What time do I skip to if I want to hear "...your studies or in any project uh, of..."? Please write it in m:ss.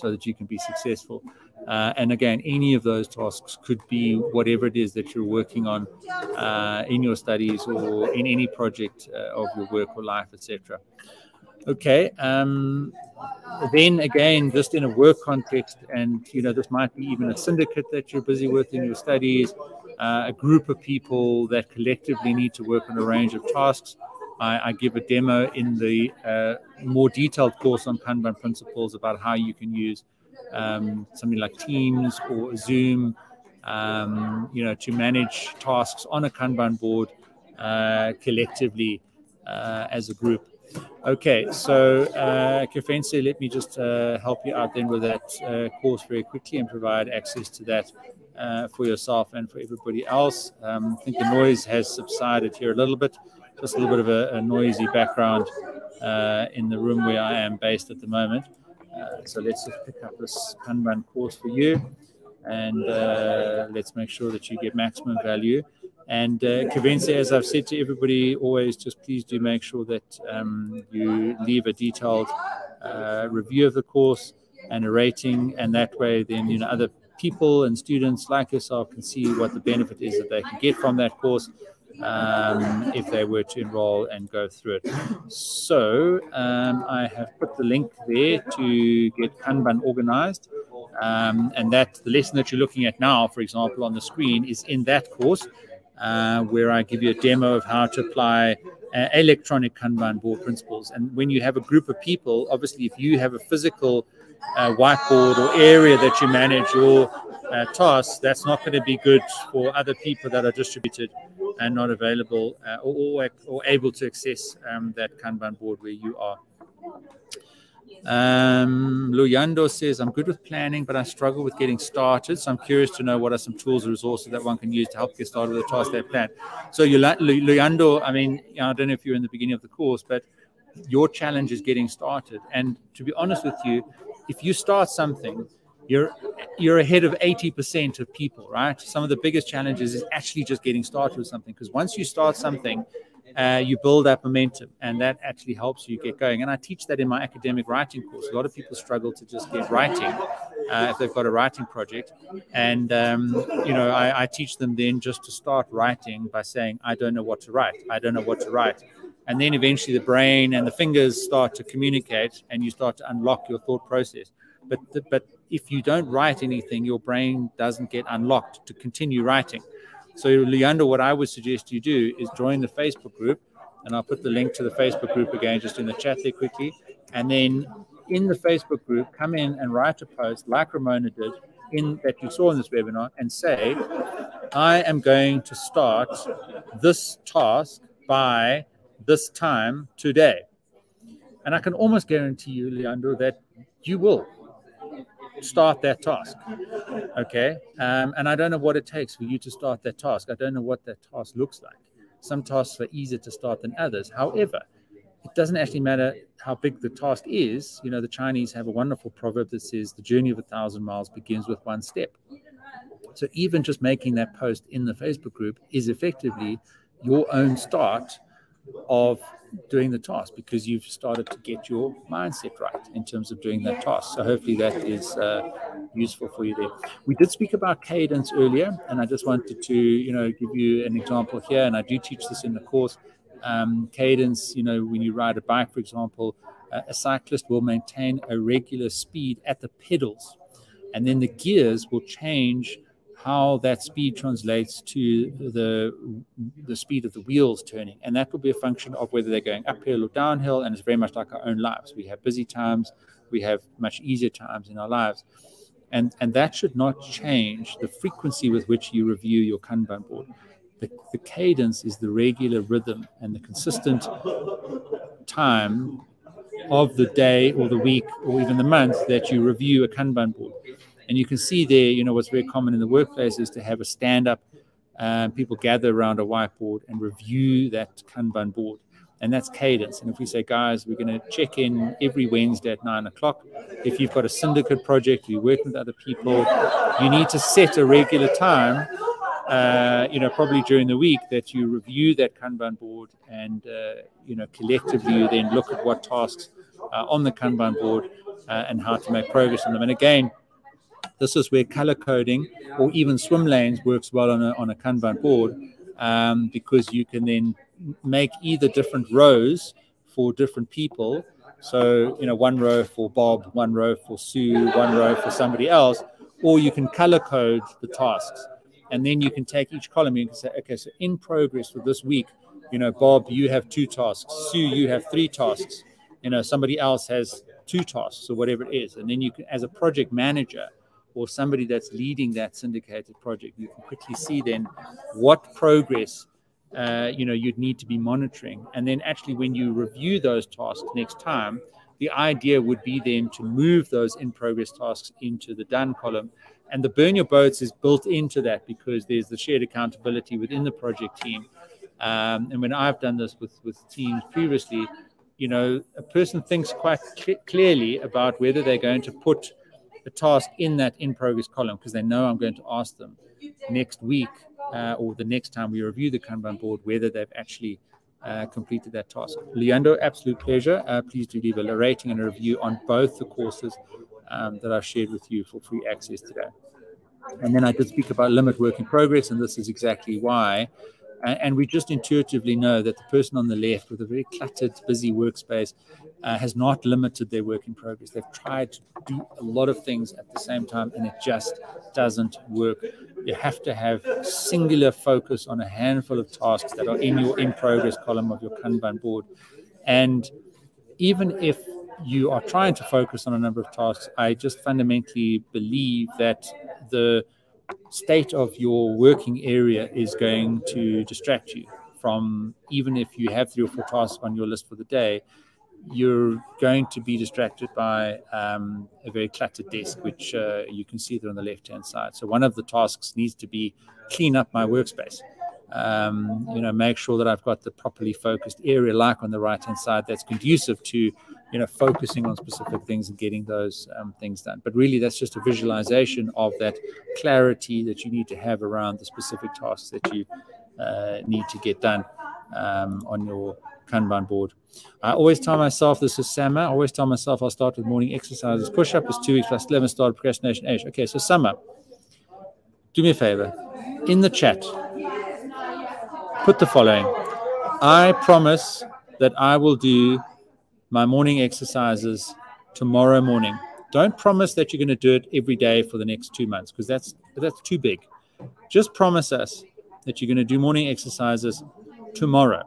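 0:07.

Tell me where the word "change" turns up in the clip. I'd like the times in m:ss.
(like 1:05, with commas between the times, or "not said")
4:02, 4:17.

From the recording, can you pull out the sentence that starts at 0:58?
Uh, so let's just pick up this Kanban course for you and uh, let's make sure that you get maximum value.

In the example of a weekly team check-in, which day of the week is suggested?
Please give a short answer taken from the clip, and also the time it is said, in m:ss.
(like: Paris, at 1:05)
Wednesday, at 4:42.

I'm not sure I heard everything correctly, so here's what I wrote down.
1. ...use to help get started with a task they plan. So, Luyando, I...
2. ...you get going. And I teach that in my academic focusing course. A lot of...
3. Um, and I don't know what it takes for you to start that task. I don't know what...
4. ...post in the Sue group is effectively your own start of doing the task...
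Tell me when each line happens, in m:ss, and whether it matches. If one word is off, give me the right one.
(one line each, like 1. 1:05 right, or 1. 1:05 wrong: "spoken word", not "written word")
1. 2:04 right
2. 2:25 wrong: "writing", not "focusing"
3. 3:17 right
4. 3:34 wrong: "Facebook", not "Sue".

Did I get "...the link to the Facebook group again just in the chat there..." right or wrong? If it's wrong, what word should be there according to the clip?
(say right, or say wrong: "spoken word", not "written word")
right.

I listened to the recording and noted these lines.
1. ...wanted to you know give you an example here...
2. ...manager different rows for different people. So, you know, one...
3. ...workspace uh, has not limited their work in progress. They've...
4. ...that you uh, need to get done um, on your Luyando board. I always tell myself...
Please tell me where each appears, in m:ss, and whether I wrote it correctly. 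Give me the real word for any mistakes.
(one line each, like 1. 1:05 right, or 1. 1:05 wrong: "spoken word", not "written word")
1. 3:49 right
2. 5:08 wrong: "either", not "manager"
3. 6:25 right
4. 7:19 wrong: "Kanban", not "Luyando".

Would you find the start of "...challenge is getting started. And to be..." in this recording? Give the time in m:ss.
2:11.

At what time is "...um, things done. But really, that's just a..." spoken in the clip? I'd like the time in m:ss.
7:13.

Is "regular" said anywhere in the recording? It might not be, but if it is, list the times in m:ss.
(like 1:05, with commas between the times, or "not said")
3:58, 4:22, 4:47.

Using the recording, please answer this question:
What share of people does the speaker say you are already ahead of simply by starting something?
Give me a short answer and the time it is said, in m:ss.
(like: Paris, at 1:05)
80%, at 2:17.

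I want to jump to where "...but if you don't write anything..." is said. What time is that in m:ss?
2:45.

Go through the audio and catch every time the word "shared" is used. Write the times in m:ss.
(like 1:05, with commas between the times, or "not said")
5:49, 6:14.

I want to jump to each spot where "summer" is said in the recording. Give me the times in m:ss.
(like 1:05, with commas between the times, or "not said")
7:26, 7:31.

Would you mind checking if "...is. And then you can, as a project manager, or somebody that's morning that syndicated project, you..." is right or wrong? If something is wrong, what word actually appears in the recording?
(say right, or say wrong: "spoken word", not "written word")
wrong: "leading", not "morning".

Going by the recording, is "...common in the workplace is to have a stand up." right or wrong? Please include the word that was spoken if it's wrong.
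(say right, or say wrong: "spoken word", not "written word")
right.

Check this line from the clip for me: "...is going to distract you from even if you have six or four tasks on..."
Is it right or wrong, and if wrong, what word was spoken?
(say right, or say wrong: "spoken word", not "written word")
wrong: "three", not "six".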